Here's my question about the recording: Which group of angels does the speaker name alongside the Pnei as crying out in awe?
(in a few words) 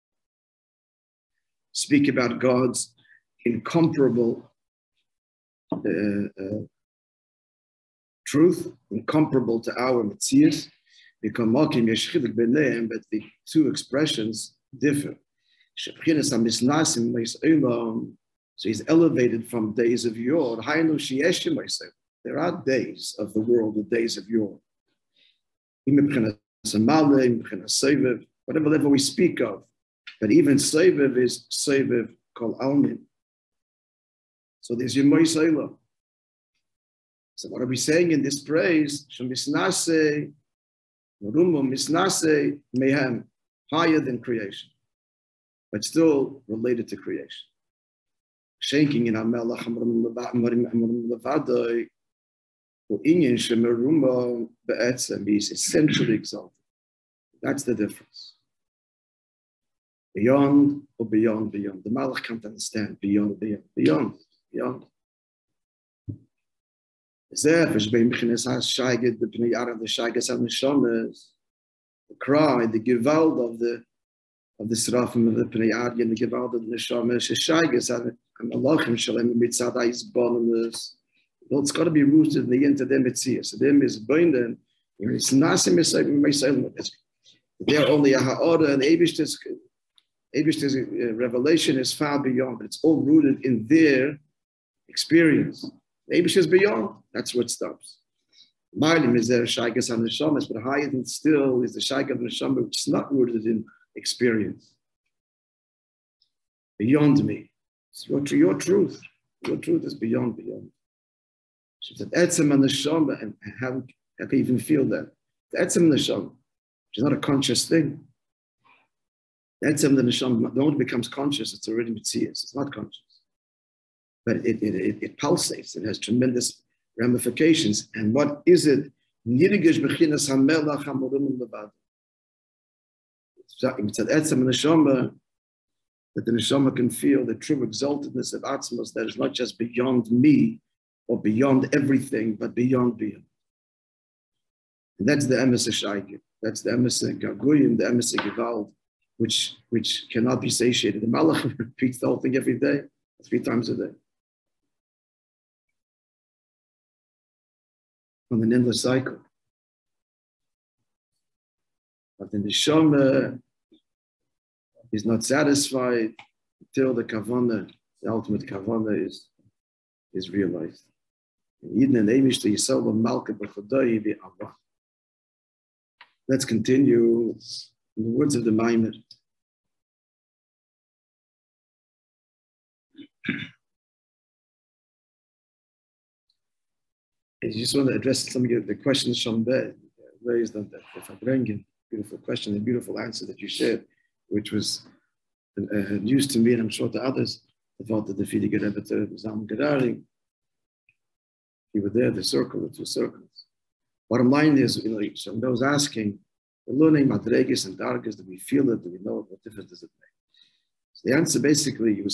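Serafim.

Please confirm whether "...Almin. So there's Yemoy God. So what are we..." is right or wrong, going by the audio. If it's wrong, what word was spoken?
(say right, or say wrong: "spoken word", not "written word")
wrong: "Selah", not "God".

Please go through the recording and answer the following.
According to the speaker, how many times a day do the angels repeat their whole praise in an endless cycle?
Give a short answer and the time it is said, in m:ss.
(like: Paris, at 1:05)
3, at 2:33.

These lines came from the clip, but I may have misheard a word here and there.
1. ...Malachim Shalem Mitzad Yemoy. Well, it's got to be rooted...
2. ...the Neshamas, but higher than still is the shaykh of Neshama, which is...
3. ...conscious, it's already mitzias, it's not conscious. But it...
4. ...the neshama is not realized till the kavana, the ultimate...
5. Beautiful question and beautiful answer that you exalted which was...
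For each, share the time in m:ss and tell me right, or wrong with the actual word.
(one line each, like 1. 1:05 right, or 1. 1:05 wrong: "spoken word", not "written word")
1. 1:18 wrong: "Aizbonimus", not "Yemoy"
2. 1:39 right
3. 2:01 right
4. 2:42 wrong: "satisfied", not "realized"
5. 3:11 wrong: "shared", not "exalted".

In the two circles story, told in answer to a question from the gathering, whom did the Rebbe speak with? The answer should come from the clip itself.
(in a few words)
Zalman Gurary.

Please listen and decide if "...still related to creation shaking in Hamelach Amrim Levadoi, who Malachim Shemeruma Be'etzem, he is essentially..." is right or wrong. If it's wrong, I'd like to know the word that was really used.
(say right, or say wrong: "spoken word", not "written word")
wrong: "Inyan", not "Malachim".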